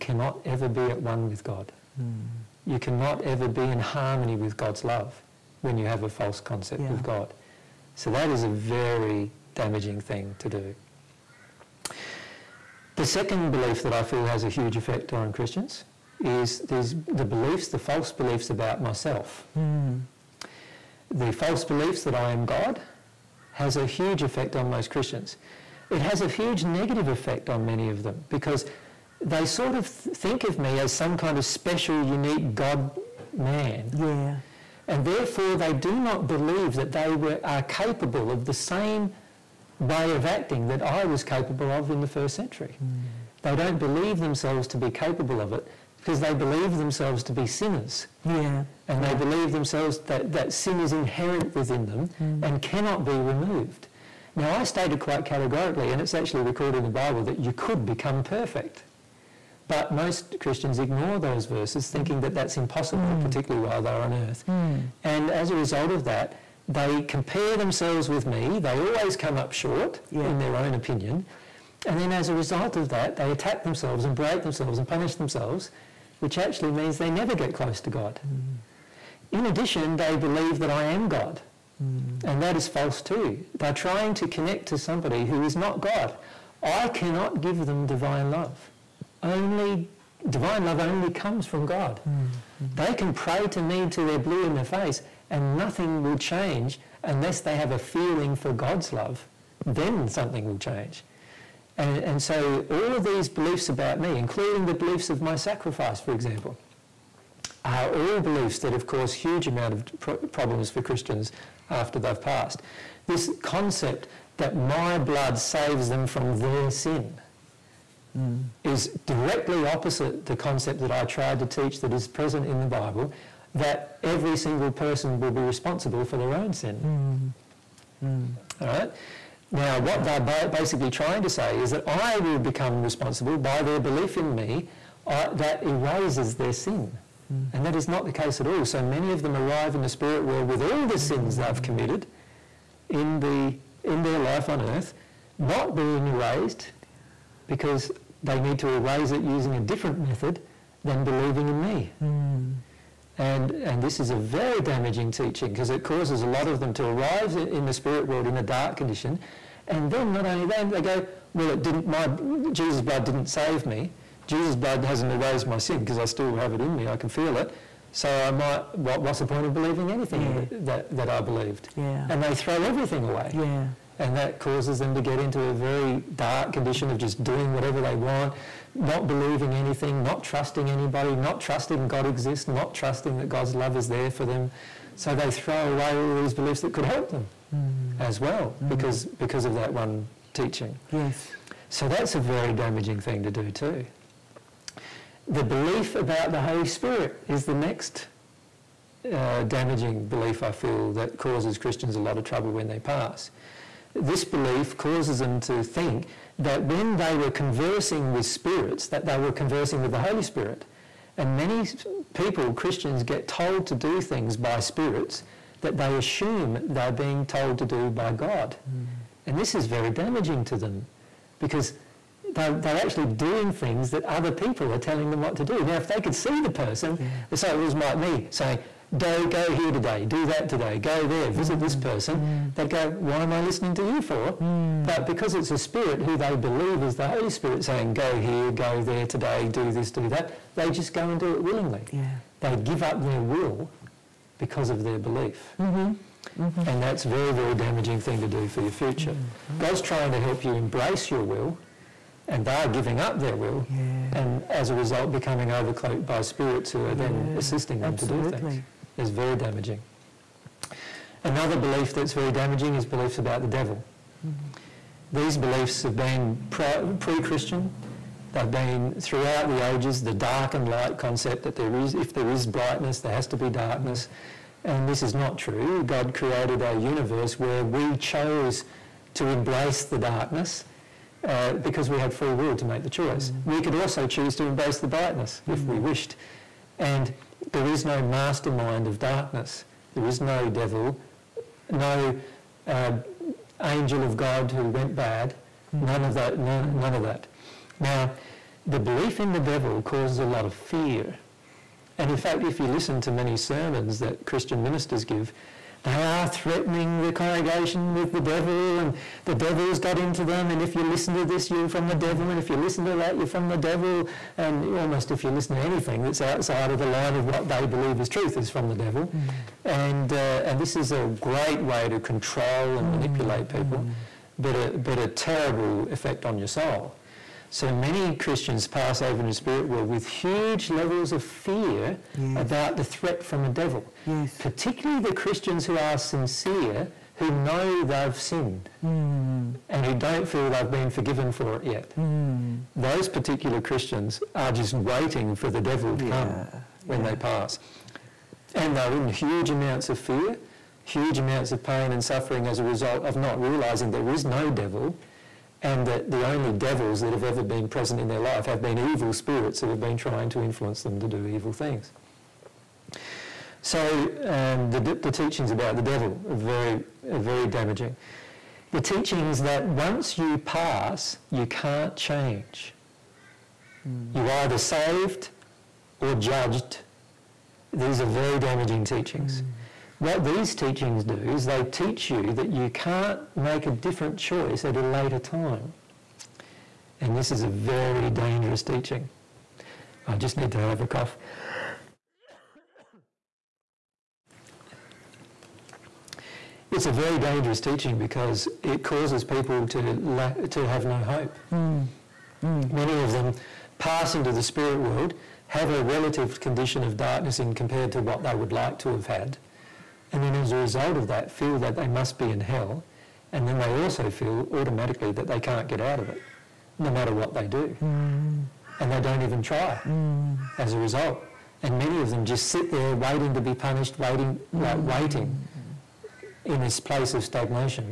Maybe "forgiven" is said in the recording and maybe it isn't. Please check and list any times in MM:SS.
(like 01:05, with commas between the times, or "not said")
05:40.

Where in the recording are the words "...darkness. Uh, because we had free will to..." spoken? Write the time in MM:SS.
04:39.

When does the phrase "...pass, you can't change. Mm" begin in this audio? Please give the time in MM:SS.
06:10.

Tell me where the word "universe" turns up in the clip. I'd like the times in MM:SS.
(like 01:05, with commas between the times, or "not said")
04:36.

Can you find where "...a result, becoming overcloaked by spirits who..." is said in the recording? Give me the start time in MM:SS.
04:14.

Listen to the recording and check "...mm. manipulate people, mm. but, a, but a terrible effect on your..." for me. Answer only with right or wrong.
right.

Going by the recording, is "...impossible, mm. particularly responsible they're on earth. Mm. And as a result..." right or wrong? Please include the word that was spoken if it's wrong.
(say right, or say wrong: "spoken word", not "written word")
wrong: "while", not "responsible".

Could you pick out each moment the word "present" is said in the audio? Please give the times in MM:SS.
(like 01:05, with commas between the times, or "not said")
02:02, 05:57.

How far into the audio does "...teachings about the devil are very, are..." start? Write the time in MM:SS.
06:05.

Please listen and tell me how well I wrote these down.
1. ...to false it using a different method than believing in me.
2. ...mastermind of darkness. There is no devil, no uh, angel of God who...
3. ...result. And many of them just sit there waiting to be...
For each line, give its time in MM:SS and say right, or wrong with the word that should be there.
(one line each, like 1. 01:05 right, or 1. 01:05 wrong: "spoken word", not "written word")
1. 02:28 wrong: "erase", not "false"
2. 04:48 right
3. 07:00 right.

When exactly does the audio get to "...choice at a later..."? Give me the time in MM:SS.
06:24.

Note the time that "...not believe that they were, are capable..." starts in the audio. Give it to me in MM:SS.
00:35.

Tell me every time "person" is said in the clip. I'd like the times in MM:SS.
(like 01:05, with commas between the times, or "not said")
02:04, 03:46, 03:51.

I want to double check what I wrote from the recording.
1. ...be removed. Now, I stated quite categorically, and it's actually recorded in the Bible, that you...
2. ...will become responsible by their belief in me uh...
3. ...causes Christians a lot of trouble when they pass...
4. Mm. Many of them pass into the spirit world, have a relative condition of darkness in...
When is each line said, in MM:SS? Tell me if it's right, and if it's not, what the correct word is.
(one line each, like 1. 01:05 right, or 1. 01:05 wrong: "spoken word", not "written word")
1. 00:53 right
2. 02:12 right
3. 03:21 right
4. 06:42 right.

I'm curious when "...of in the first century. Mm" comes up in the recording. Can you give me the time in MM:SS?
00:41.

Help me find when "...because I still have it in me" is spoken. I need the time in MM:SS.
02:45.